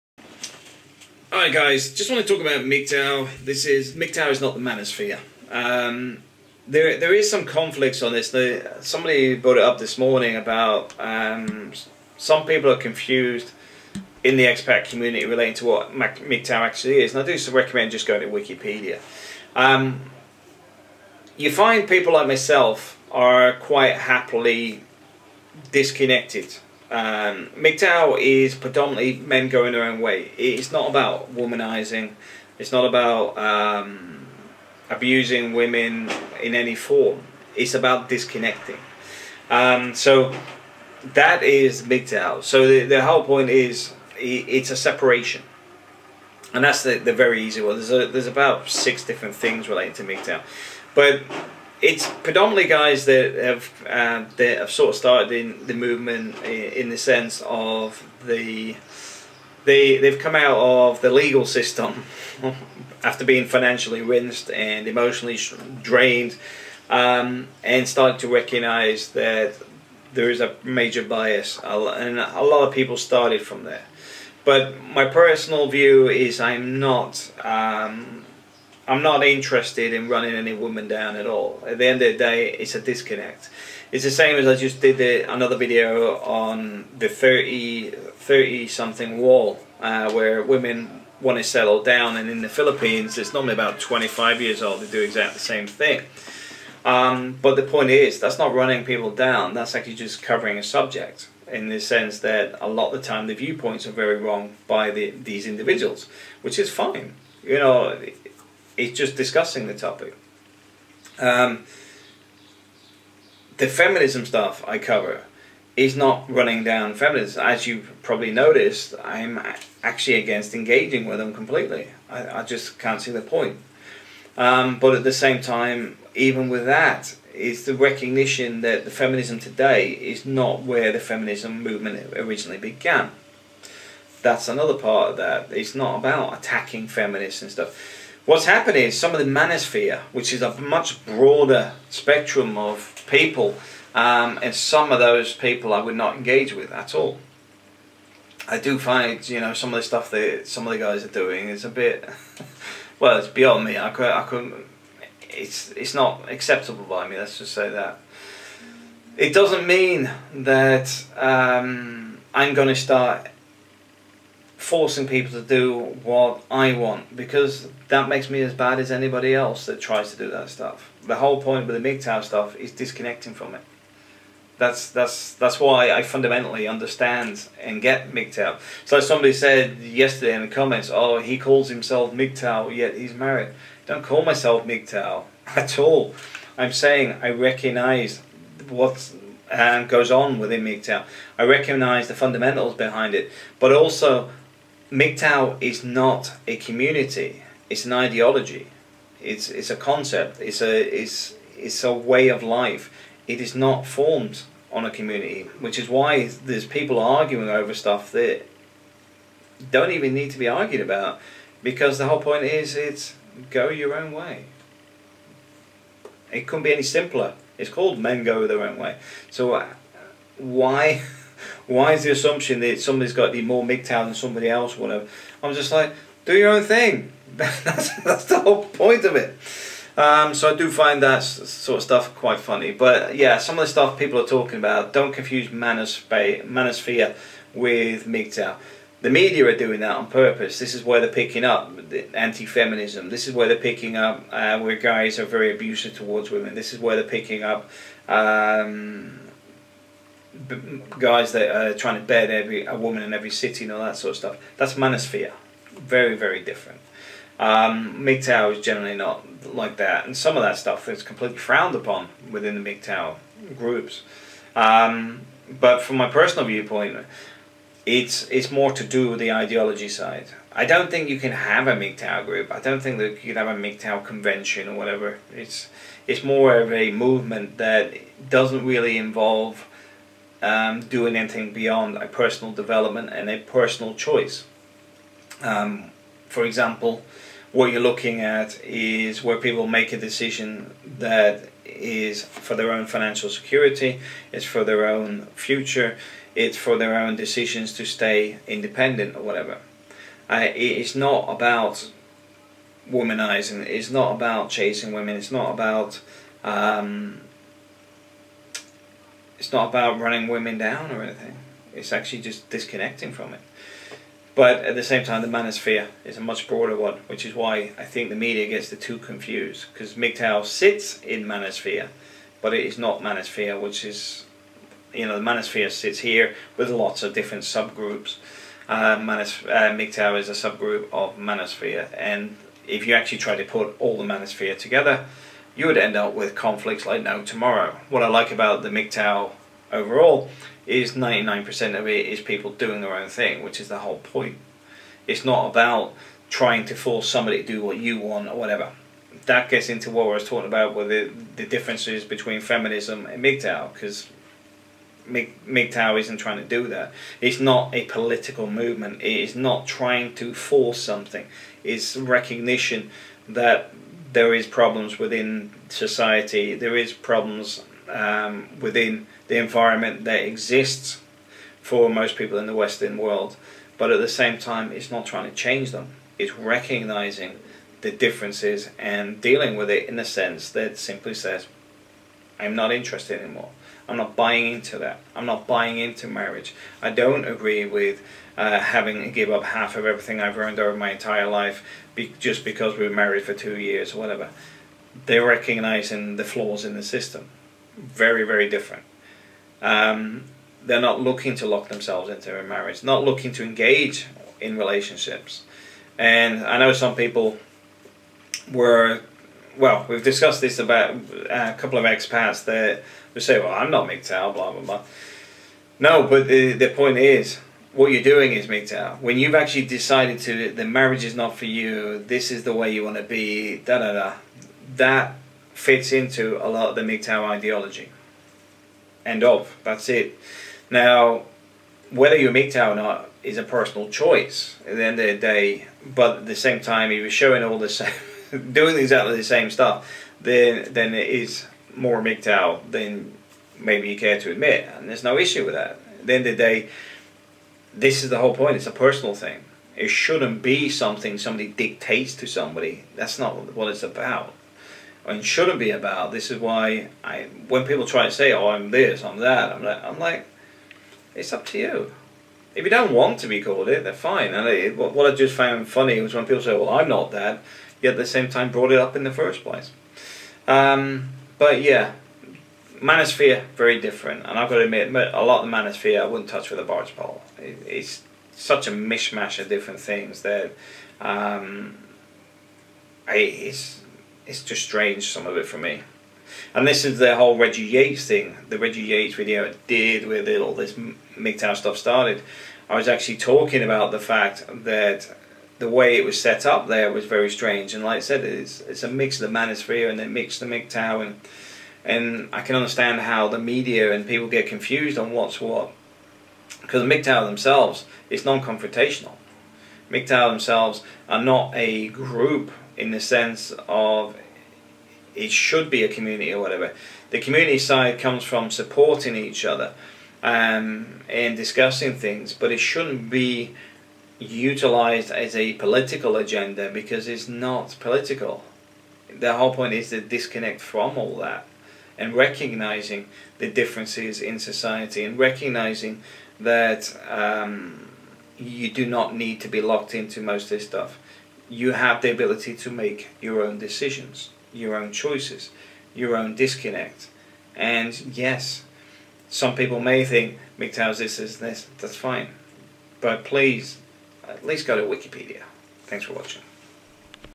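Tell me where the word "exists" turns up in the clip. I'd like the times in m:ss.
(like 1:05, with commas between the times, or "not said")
6:10.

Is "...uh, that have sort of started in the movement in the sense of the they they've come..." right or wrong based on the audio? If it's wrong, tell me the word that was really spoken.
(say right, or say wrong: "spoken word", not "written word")
right.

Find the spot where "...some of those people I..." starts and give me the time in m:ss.
2:24.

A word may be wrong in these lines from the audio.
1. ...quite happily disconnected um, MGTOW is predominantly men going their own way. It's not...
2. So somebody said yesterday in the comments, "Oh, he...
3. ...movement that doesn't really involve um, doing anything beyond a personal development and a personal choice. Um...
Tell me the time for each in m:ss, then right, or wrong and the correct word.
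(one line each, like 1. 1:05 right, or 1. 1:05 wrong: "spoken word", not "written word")
1. 0:23 right
2. 2:58 right
3. 4:36 right.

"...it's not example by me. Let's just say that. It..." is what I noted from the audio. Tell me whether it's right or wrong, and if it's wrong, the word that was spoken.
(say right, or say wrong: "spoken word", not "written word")
wrong: "acceptable", not "example".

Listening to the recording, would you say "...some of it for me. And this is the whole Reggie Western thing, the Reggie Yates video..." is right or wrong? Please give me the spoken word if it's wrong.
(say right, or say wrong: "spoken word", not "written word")
wrong: "Yates", not "Western".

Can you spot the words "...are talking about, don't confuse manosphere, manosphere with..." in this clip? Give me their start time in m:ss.
3:54.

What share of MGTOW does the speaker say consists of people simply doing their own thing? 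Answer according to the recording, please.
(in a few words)
99%.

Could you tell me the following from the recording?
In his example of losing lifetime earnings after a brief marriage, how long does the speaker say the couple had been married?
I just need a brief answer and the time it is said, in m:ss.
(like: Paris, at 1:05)
2 years, at 6:33.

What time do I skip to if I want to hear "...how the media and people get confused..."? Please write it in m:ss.
8:23.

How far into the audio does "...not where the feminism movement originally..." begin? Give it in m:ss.
2:10.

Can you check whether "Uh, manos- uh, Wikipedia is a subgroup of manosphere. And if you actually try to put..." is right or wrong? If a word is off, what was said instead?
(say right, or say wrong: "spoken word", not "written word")
wrong: "MGTOW", not "Wikipedia".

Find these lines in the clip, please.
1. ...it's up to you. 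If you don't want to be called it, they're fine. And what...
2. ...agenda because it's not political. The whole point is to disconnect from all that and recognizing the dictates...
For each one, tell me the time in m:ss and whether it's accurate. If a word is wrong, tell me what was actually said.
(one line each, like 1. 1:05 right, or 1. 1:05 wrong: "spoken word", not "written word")
1. 7:41 right
2. 8:46 wrong: "differences", not "dictates".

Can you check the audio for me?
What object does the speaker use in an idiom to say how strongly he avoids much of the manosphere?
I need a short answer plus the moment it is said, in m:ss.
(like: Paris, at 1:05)
barge pole, at 7:56.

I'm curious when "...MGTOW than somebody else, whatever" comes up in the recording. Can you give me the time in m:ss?
3:43.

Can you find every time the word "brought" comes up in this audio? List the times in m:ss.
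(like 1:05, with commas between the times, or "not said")
0:09, 7:48.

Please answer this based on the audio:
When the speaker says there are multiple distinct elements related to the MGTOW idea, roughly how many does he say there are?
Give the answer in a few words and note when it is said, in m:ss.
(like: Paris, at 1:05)
6, at 0:48.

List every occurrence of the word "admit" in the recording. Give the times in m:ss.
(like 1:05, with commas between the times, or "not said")
7:24, 7:54.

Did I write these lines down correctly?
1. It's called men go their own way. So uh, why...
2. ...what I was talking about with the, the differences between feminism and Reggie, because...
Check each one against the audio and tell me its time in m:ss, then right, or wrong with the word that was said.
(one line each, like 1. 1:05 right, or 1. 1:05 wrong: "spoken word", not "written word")
1. 3:37 right
2. 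5:49 wrong: "MGTOW", not "Reggie".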